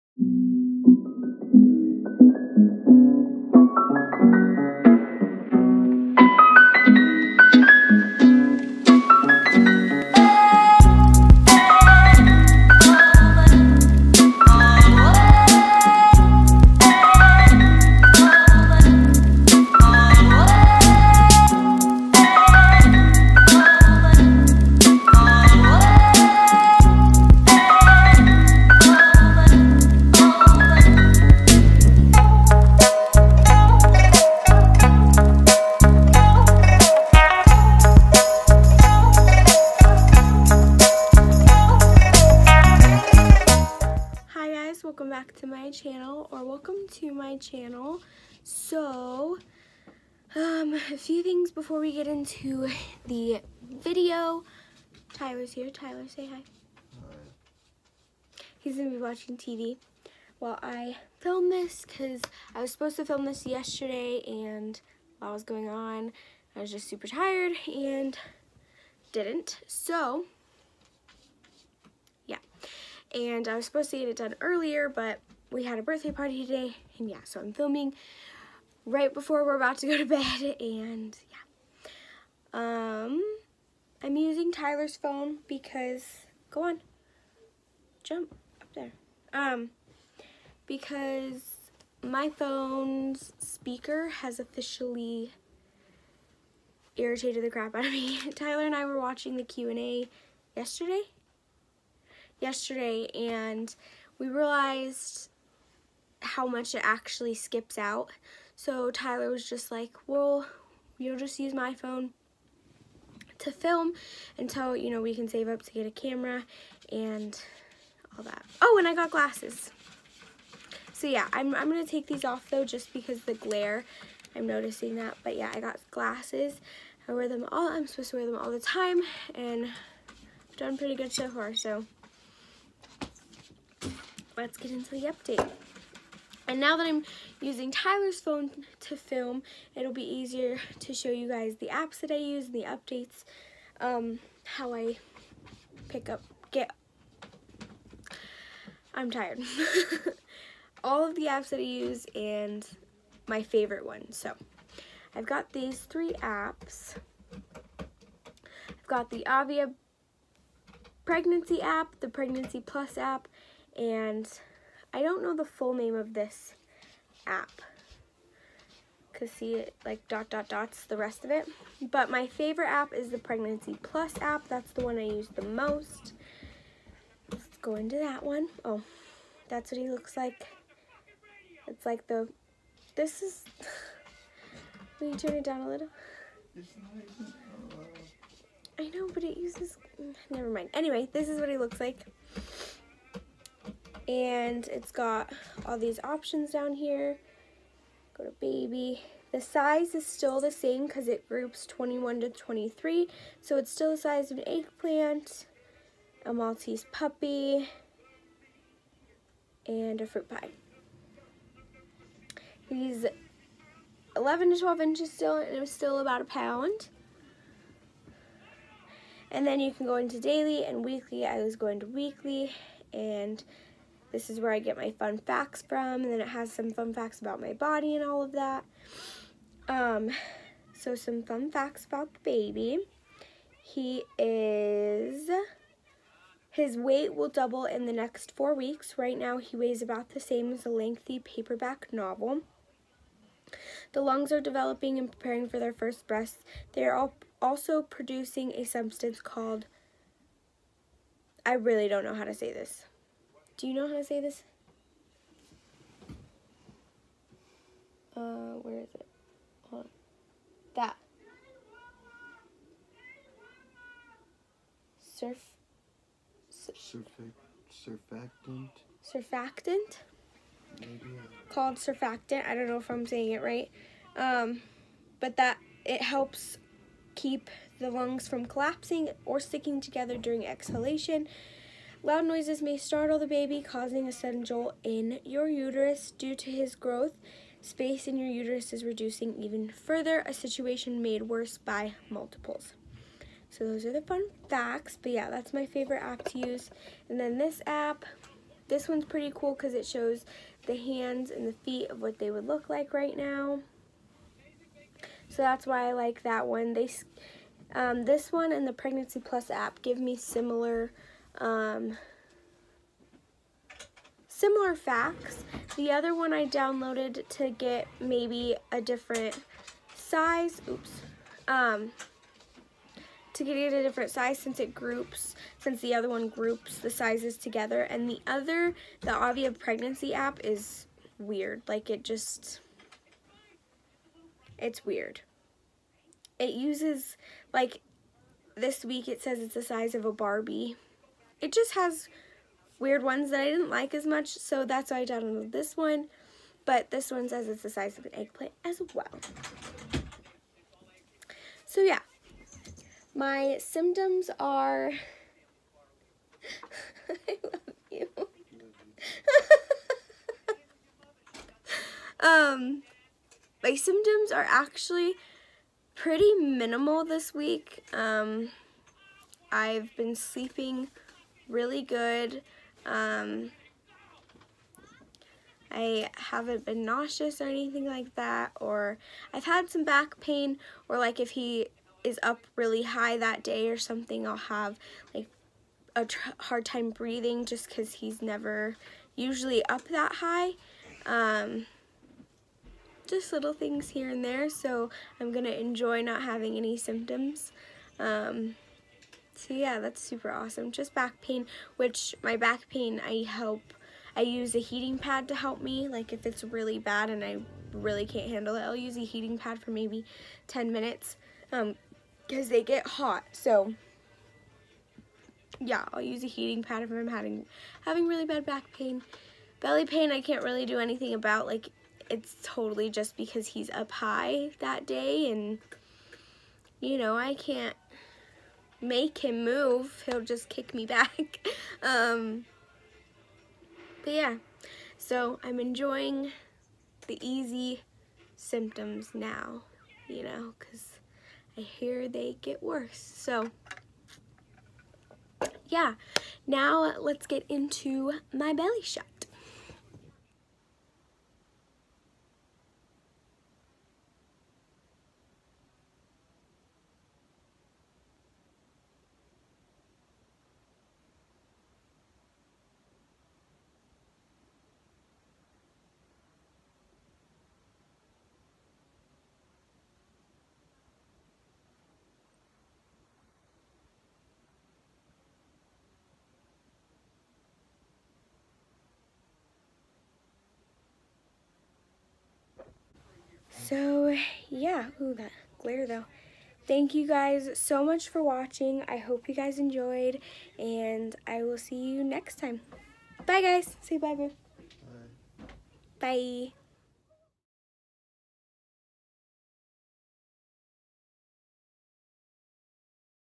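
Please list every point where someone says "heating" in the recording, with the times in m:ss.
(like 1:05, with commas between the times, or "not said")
6:44, 6:49, 6:56.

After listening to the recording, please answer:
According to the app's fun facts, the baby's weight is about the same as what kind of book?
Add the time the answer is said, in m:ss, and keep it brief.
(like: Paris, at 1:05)
lengthy paperback novel, at 4:00.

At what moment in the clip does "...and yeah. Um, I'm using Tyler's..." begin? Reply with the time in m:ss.
1:20.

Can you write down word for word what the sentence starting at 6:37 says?
Um, so yeah, that's super awesome.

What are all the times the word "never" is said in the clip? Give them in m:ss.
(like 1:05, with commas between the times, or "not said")
3:10, 6:28.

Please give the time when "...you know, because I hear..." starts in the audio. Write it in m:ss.
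7:20.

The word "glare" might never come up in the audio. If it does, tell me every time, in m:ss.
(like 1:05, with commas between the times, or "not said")
2:03, 8:05.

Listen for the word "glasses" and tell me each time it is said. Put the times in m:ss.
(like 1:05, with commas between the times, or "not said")
1:59, 2:05.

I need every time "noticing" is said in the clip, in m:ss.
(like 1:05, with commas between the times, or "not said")
2:04.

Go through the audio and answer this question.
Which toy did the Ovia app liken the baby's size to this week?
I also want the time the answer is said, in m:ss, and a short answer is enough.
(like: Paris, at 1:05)
Barbie, at 5:40.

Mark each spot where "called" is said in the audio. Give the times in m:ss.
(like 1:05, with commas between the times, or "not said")
4:09, 4:31.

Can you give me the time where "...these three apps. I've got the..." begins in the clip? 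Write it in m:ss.
2:35.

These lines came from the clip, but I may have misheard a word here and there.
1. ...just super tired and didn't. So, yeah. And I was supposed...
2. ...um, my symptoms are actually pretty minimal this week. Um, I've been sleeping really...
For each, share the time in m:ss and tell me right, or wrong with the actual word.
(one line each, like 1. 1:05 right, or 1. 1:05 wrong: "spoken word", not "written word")
1. 1:06 right
2. 6:02 right.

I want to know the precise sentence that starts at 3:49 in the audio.
Um, so some fun facts about the baby.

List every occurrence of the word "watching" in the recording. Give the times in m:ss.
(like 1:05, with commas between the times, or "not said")
0:59, 1:38, 8:08.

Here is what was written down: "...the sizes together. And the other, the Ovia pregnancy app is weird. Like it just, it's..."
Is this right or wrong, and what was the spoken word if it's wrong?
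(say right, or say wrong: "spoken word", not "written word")
right.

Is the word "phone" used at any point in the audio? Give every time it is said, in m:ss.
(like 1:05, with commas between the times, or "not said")
1:24, 1:32, 1:51, 2:18.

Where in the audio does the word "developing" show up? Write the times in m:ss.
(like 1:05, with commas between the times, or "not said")
4:04.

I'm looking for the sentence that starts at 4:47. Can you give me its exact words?
Space in your uterus is reducing even further, a situation made worse by multiples.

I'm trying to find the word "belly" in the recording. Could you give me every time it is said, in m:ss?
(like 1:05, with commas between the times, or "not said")
6:59, 7:28.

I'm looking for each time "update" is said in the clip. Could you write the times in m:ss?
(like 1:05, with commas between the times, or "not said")
2:15, 2:22.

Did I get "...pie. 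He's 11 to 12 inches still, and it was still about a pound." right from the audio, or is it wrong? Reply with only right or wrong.
right.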